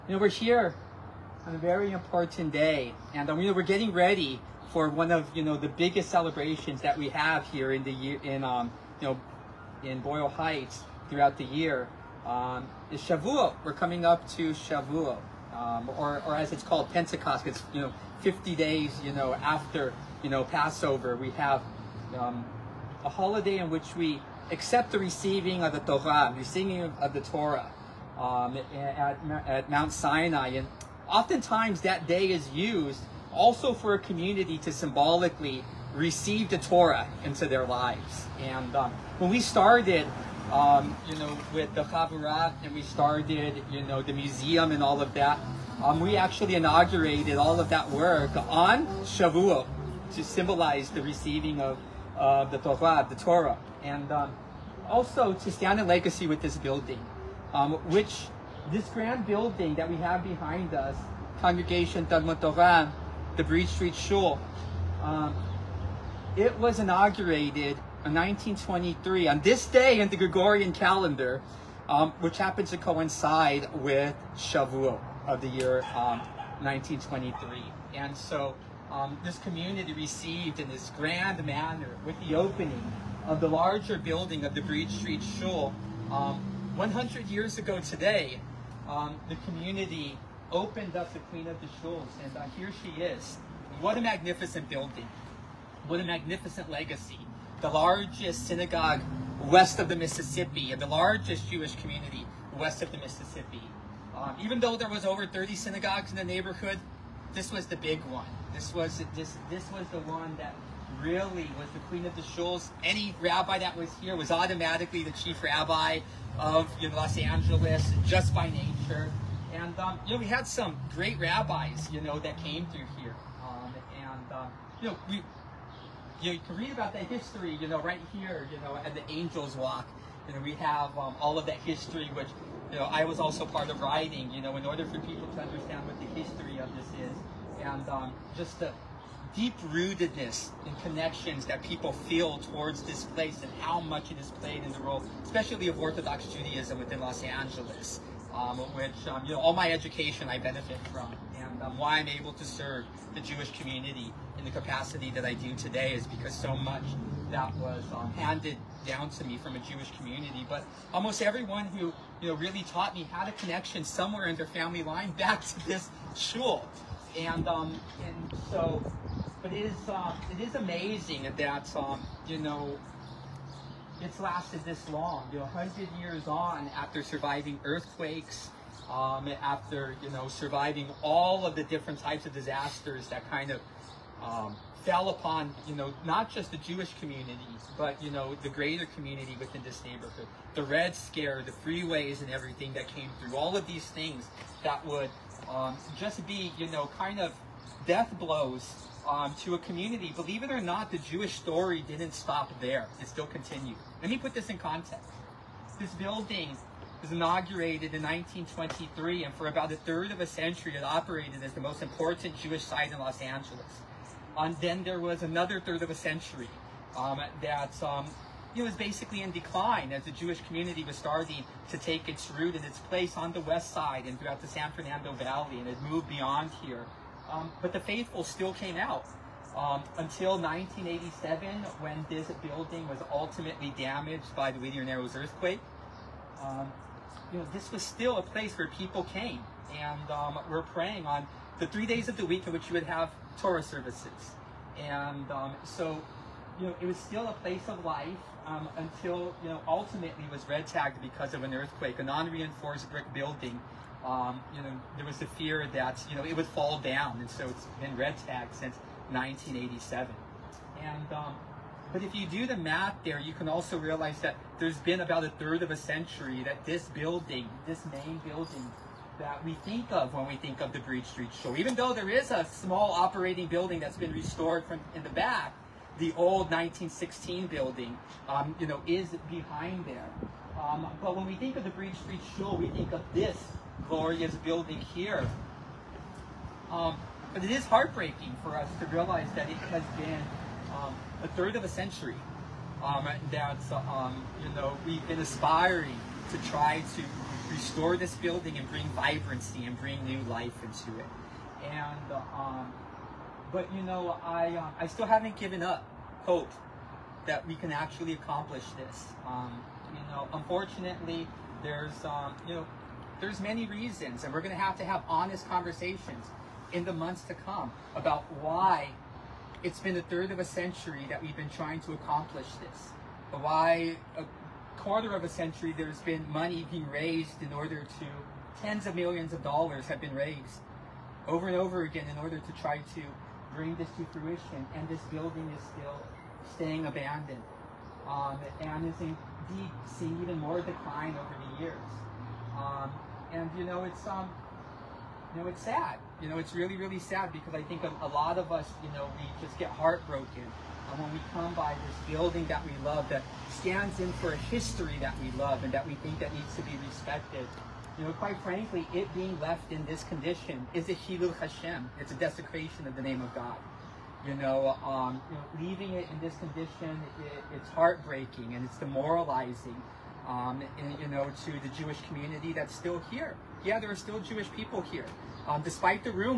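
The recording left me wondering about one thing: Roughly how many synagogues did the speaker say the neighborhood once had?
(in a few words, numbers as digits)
over 30.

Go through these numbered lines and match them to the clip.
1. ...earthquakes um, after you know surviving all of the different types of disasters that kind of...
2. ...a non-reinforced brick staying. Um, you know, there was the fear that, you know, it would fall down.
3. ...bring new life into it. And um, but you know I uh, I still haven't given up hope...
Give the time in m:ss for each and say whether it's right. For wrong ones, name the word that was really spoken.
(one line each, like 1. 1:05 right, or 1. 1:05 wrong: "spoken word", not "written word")
1. 2:57 right
2. 4:11 wrong: "building", not "staying"
3. 4:59 right.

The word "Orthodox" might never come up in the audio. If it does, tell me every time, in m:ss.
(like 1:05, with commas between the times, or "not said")
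2:25.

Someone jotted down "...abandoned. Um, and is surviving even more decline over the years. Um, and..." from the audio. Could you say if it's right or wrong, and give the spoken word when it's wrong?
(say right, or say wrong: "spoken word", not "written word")
wrong: "seeing", not "surviving".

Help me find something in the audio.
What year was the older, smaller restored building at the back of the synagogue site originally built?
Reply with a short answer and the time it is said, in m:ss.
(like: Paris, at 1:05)
1916, at 4:36.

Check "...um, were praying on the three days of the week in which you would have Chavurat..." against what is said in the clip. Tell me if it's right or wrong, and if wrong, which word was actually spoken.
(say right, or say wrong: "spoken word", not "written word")
wrong: "Torah", not "Chavurat".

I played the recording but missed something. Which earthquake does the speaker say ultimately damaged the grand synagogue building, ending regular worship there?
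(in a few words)
Whittier Narrows earthquake.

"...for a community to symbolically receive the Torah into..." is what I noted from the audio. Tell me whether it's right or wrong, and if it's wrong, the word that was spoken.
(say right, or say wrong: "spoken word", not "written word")
right.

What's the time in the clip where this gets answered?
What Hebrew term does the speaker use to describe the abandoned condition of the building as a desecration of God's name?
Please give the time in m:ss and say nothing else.
6:00.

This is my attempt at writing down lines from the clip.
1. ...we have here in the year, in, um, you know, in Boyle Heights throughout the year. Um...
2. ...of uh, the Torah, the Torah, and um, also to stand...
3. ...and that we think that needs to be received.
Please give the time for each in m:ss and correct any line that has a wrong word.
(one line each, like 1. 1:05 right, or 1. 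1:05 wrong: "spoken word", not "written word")
1. 0:06 right
2. 0:51 right
3. 5:55 wrong: "respected", not "received".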